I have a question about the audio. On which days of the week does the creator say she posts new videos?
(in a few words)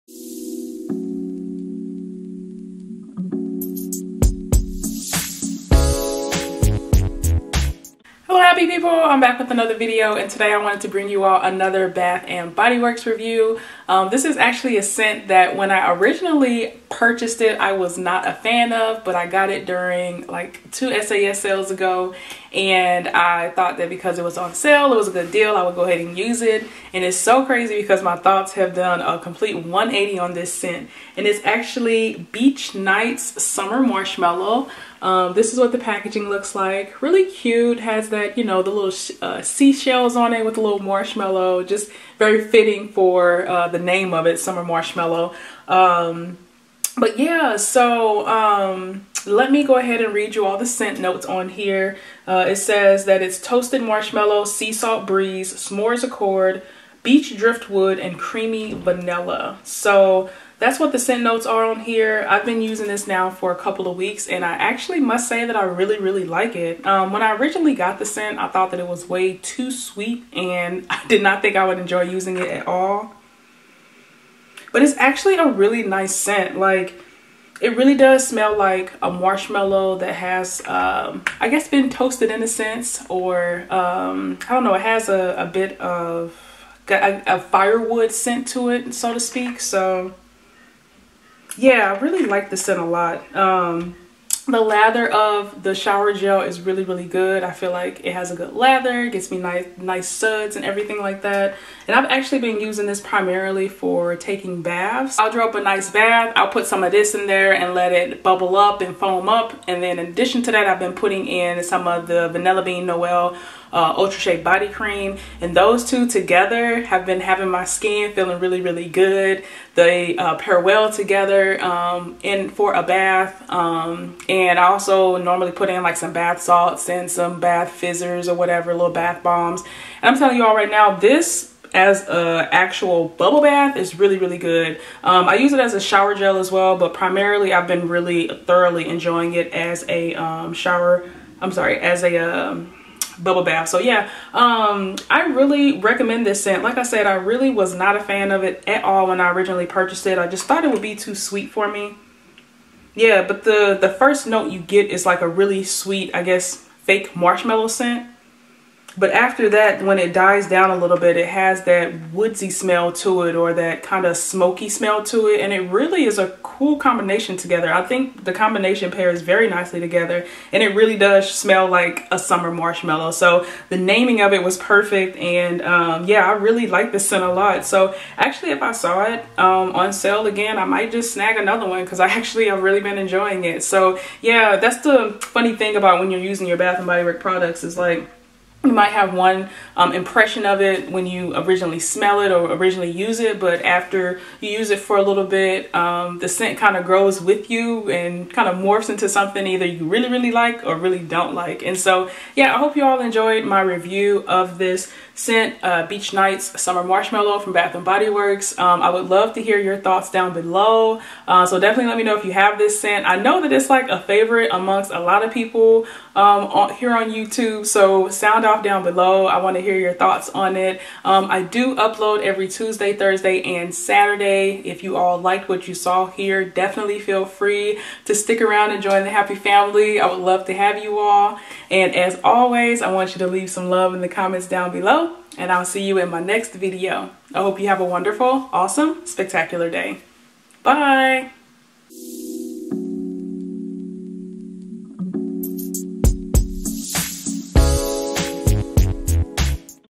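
Tuesday, Thursday, and Saturday.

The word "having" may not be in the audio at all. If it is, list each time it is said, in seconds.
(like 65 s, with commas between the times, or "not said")
117 s.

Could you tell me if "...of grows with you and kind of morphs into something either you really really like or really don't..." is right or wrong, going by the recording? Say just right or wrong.
right.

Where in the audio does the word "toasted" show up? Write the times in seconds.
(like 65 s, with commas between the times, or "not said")
53 s, 81 s.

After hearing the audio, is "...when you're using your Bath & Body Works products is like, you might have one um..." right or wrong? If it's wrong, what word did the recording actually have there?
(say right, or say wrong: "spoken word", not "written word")
right.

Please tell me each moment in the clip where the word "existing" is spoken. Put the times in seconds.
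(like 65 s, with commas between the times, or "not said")
not said.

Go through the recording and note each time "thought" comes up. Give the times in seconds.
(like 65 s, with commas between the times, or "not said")
23 s, 28 s, 68 s, 150 s, 209 s, 219 s.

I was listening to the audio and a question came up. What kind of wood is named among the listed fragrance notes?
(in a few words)
Beach driftwood.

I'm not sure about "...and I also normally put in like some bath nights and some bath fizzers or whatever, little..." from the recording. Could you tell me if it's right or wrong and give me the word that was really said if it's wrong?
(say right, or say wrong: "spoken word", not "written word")
wrong: "salts", not "nights".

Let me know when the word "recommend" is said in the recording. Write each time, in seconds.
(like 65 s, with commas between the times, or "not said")
145 s.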